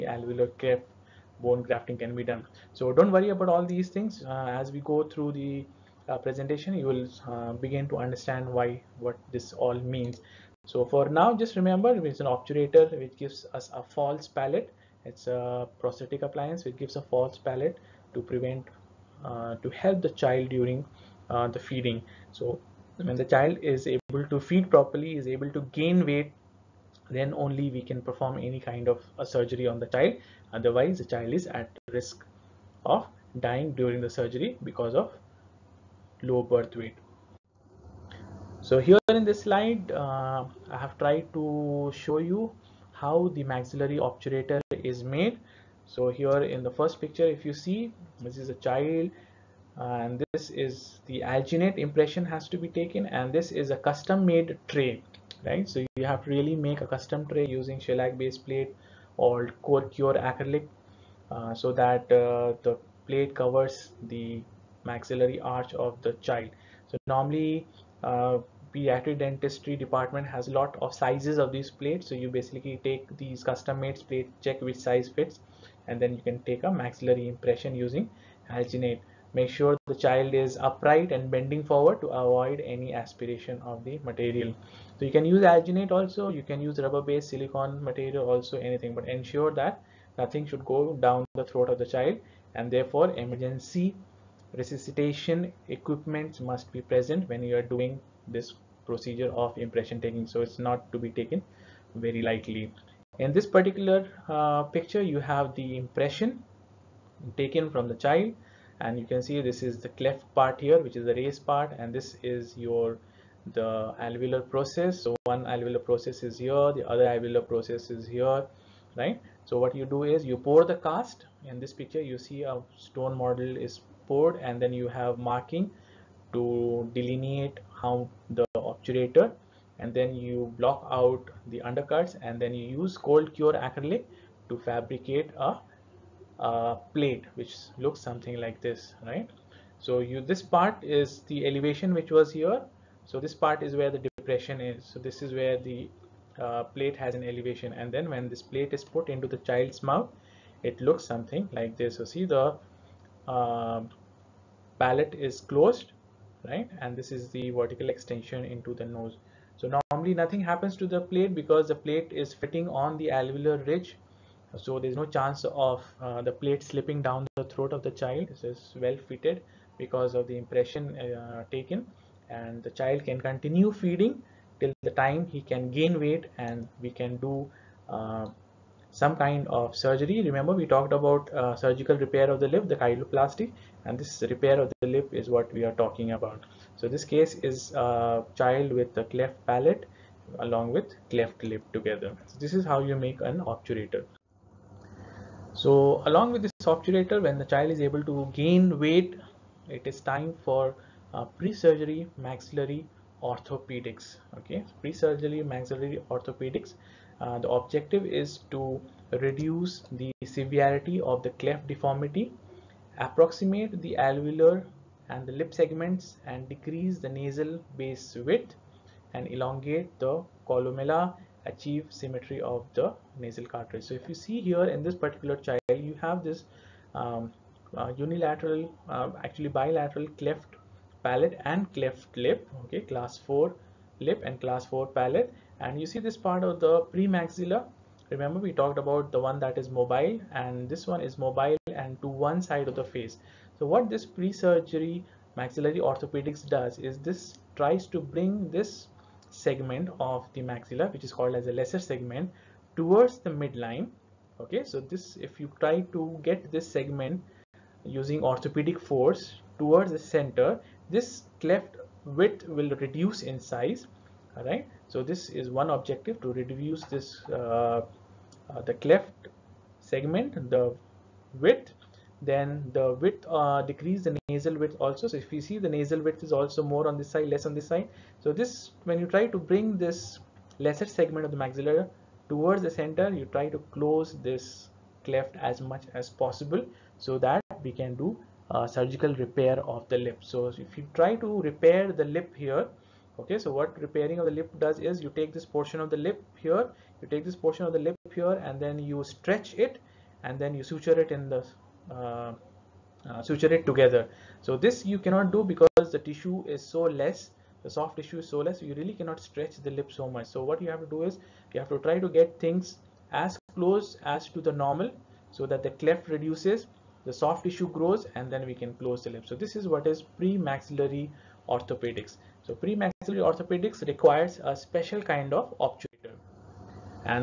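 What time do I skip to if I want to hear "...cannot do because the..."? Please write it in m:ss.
5:04.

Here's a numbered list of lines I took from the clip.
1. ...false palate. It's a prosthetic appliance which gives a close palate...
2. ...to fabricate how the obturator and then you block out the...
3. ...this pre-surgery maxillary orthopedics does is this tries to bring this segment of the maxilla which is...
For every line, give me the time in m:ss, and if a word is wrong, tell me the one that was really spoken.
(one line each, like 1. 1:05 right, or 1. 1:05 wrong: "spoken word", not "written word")
1. 0:13 wrong: "false", not "close"
2. 2:06 wrong: "delineate", not "fabricate"
3. 4:03 right.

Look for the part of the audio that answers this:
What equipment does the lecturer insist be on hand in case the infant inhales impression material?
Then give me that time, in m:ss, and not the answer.
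1:33.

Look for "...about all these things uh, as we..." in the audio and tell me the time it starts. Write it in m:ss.
0:03.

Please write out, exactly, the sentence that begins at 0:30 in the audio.
Otherwise, the child is at risk of dying during the surgery because of low birth weight.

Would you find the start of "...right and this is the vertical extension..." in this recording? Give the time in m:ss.
2:36.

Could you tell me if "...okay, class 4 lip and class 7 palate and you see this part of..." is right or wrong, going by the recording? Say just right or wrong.
wrong.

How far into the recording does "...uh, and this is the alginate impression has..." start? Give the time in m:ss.
0:49.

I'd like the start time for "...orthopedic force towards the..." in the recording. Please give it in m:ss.
4:18.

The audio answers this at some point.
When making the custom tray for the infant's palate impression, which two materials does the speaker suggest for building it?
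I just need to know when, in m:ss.
0:57.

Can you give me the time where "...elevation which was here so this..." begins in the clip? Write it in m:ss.
2:21.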